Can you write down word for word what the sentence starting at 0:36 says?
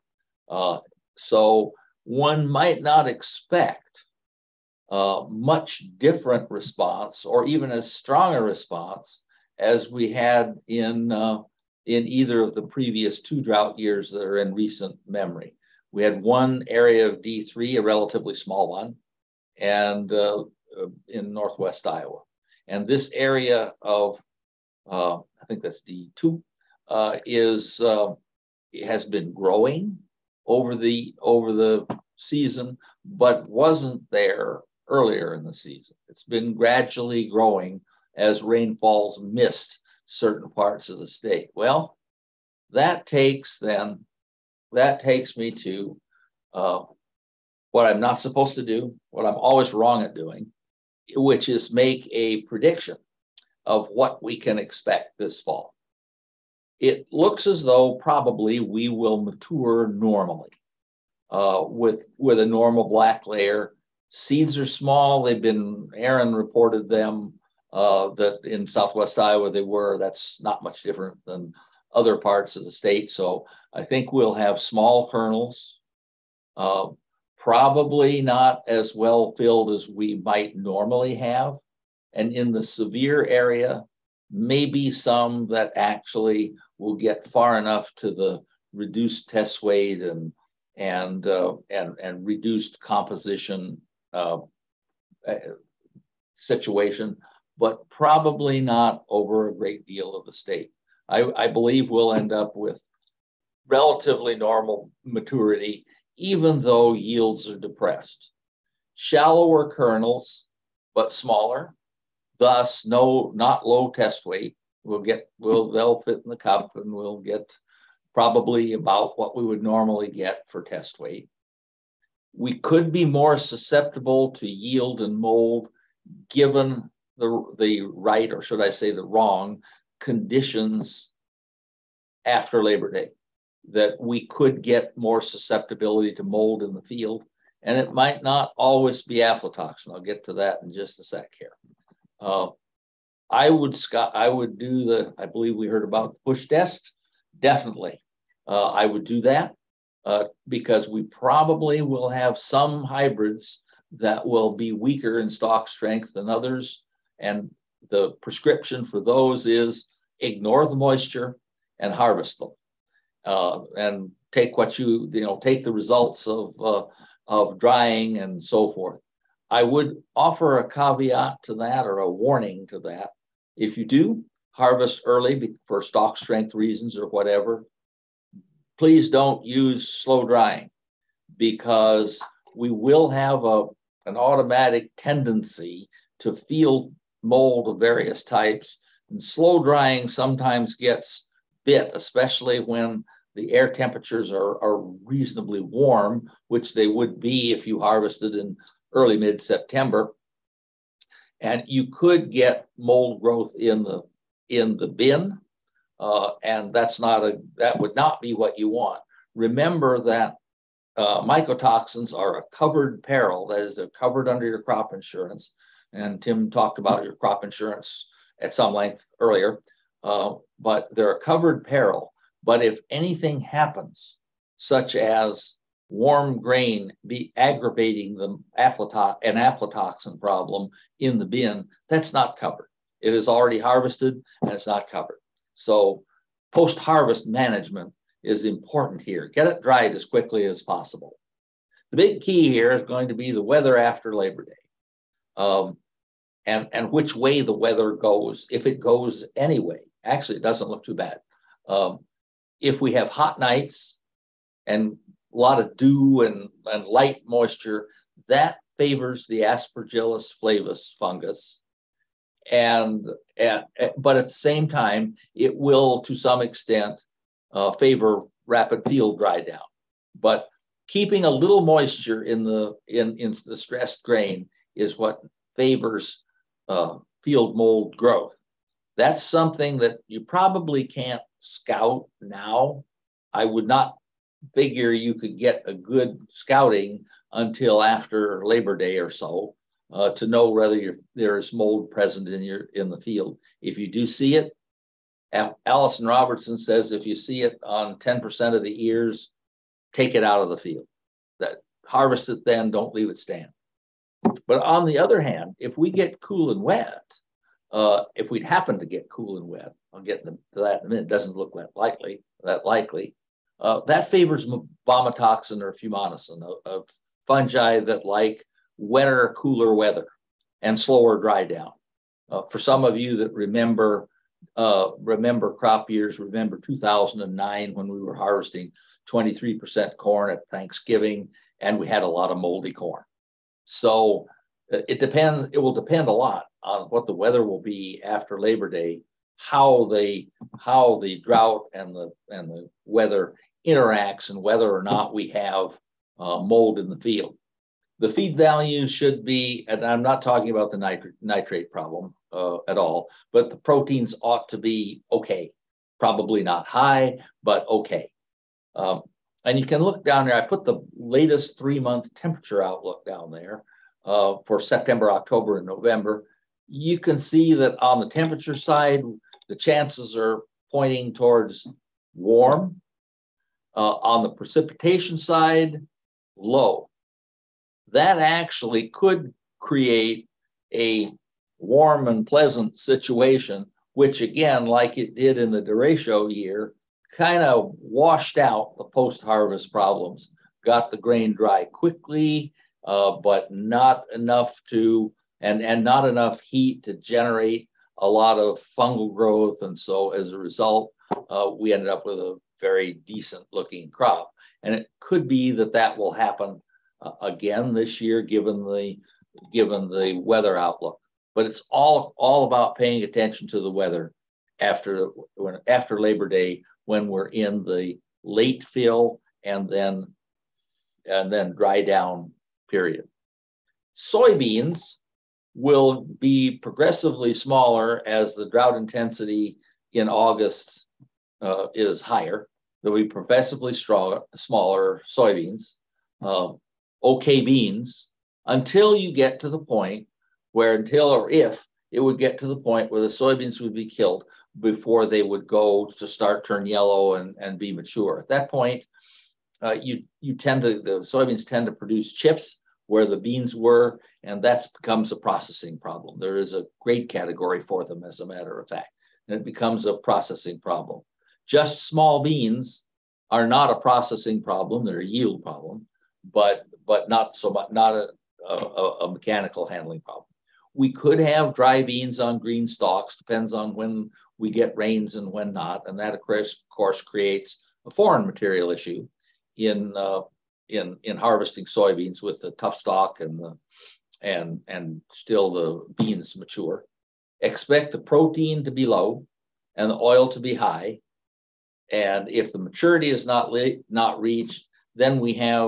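It's been gradually growing as rainfalls missed certain parts of the state.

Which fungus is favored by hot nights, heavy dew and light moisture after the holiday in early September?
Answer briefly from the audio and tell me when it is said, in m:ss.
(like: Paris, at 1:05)
Aspergillus flavus, at 4:19.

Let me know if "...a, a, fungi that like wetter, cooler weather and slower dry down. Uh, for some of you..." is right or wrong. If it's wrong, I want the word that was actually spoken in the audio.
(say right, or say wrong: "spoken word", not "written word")
right.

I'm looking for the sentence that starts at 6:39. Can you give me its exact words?
And so as a result, uh, we ended up with a very decent looking crop.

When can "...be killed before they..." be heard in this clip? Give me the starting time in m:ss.
7:23.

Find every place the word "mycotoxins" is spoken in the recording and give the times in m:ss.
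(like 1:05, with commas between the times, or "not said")
3:31.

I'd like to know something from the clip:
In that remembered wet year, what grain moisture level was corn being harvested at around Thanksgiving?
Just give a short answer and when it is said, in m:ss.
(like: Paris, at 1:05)
23%, at 5:29.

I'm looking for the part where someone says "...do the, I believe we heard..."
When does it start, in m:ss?
2:24.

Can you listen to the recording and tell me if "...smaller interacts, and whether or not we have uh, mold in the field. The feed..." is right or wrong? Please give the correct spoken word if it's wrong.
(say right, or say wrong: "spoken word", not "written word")
wrong: "weather", not "smaller".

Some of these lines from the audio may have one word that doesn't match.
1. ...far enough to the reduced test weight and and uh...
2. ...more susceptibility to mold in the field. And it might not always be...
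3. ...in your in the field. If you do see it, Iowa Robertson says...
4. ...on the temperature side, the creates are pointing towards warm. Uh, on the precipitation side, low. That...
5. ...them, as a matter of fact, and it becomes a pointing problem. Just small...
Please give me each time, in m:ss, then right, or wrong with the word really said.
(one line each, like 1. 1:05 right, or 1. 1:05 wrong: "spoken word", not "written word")
1. 1:27 right
2. 2:14 right
3. 4:52 wrong: "Alison", not "Iowa"
4. 6:07 wrong: "chances", not "creates"
5. 7:37 wrong: "processing", not "pointing".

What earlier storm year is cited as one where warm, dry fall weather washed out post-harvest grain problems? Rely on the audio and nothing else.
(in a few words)
The derecho year.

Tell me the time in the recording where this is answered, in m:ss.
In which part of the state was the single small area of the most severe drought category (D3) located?
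0:21.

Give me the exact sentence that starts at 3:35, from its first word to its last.
And Tim talked about your crop insurance at some length earlier, uh, but they're a covered peril.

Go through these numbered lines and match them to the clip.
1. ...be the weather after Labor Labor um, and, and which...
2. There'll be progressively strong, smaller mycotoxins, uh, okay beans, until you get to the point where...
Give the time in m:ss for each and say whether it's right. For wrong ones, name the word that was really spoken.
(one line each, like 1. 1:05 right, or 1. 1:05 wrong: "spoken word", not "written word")
1. 4:03 wrong: "Day", not "Labor"
2. 7:12 wrong: "soybeans", not "mycotoxins".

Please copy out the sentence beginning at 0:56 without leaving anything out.
It looks as though probably we will mature normally uh, with, with a normal black layer.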